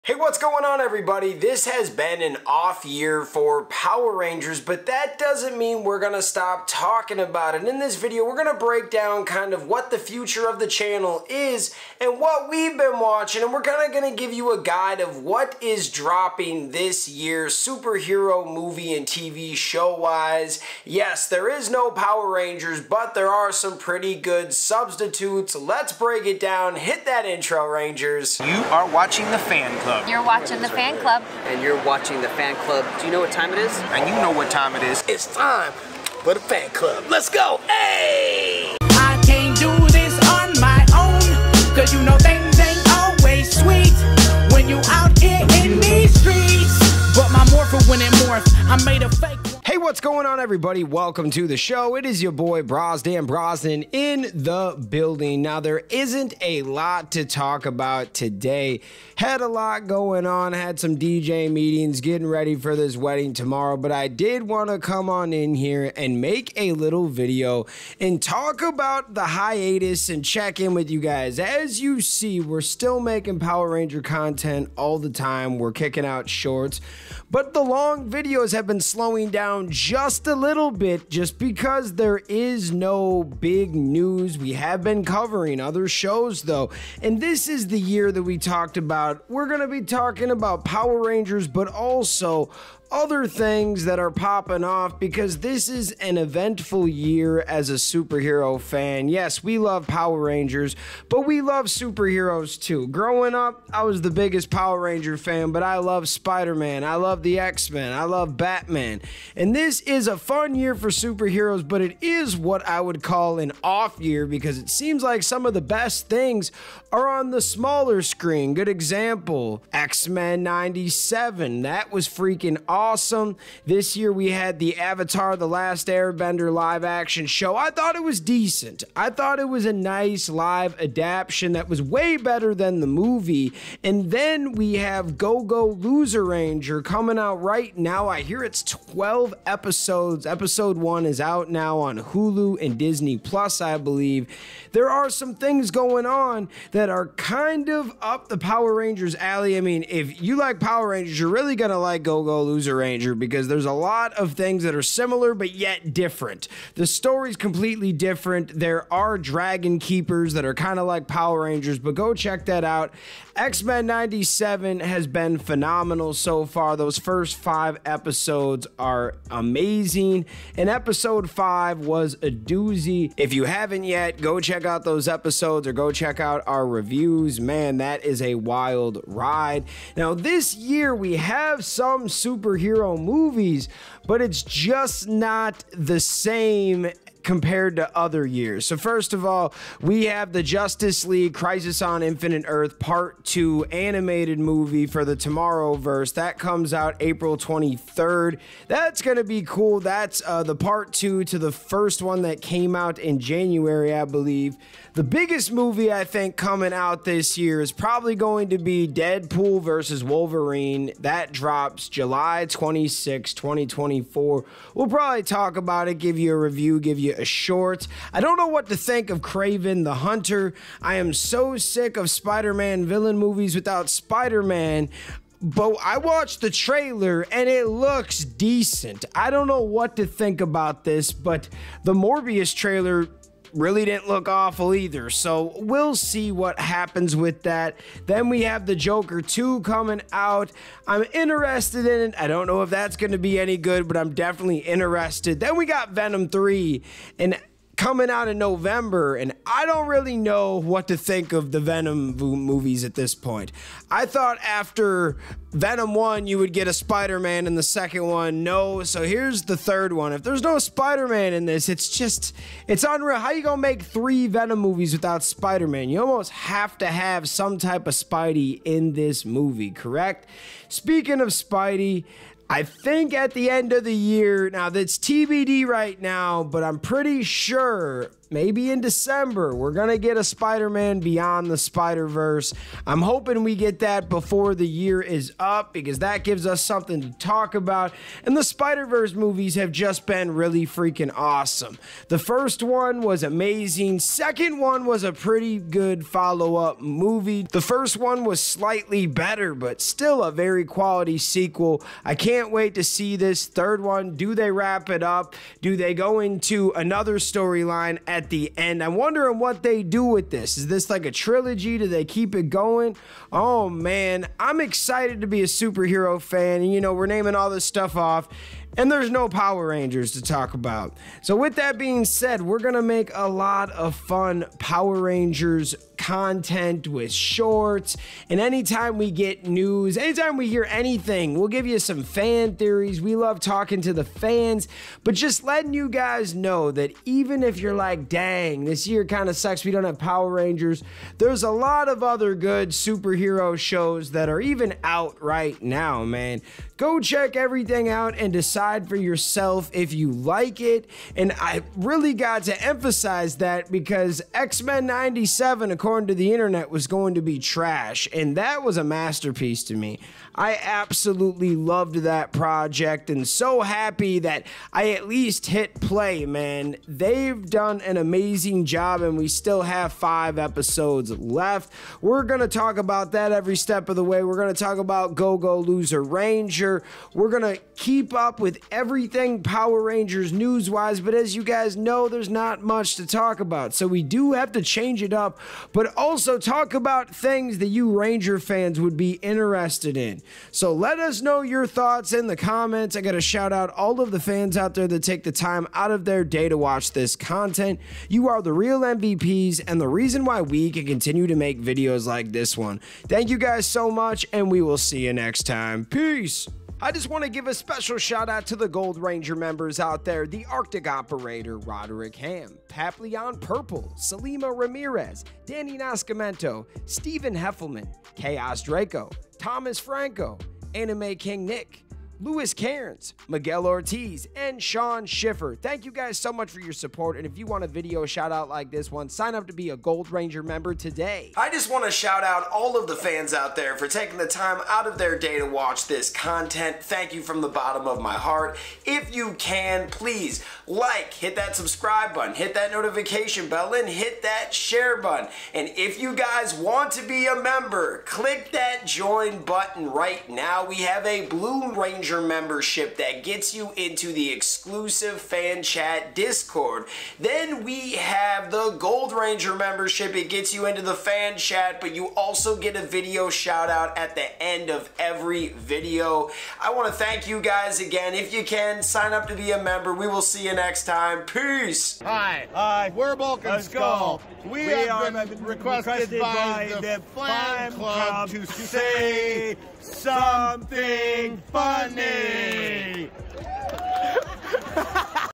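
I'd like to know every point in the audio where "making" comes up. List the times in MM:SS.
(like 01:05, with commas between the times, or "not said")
01:12.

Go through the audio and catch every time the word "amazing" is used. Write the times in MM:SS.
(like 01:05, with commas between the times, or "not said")
02:49, 04:53, 06:07.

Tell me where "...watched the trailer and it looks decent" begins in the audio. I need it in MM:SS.
03:45.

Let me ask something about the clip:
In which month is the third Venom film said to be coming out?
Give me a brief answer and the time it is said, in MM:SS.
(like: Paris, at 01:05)
November, at 04:08.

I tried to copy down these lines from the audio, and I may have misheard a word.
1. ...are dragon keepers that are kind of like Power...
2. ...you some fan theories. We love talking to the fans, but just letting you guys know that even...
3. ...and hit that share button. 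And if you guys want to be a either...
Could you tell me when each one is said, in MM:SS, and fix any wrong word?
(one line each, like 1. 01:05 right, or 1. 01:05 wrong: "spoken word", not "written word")
1. 02:38 right
2. 05:31 right
3. 07:23 wrong: "member", not "either".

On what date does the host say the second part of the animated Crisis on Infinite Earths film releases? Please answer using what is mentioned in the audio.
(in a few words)
April 23rd.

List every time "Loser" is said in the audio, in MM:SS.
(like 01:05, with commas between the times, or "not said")
02:15, 02:32, 06:15.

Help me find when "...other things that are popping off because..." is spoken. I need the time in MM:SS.
01:32.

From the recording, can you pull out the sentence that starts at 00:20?
Yes, there is no Power Rangers, but there are some pretty good substitutes.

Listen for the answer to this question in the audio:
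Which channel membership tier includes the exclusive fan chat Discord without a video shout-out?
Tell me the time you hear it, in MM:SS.
07:31.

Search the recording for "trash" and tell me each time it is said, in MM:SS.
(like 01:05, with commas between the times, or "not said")
05:57.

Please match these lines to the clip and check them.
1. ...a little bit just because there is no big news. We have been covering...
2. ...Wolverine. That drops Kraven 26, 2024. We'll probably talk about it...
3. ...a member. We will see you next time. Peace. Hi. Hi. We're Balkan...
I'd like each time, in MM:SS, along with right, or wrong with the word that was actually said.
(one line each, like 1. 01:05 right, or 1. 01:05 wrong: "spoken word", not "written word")
1. 01:20 right
2. 03:30 wrong: "July", not "Kraven"
3. 07:49 right.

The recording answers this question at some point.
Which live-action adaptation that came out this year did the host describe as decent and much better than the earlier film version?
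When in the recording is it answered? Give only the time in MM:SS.
02:04.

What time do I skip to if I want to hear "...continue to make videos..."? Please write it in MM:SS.
06:40.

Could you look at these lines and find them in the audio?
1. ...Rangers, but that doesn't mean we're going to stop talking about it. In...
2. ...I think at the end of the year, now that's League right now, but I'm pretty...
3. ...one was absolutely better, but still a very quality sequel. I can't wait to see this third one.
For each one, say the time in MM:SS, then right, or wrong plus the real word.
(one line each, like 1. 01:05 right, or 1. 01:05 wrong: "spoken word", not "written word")
1. 00:04 right
2. 04:32 wrong: "TBD", not "League"
3. 04:57 wrong: "slightly", not "absolutely".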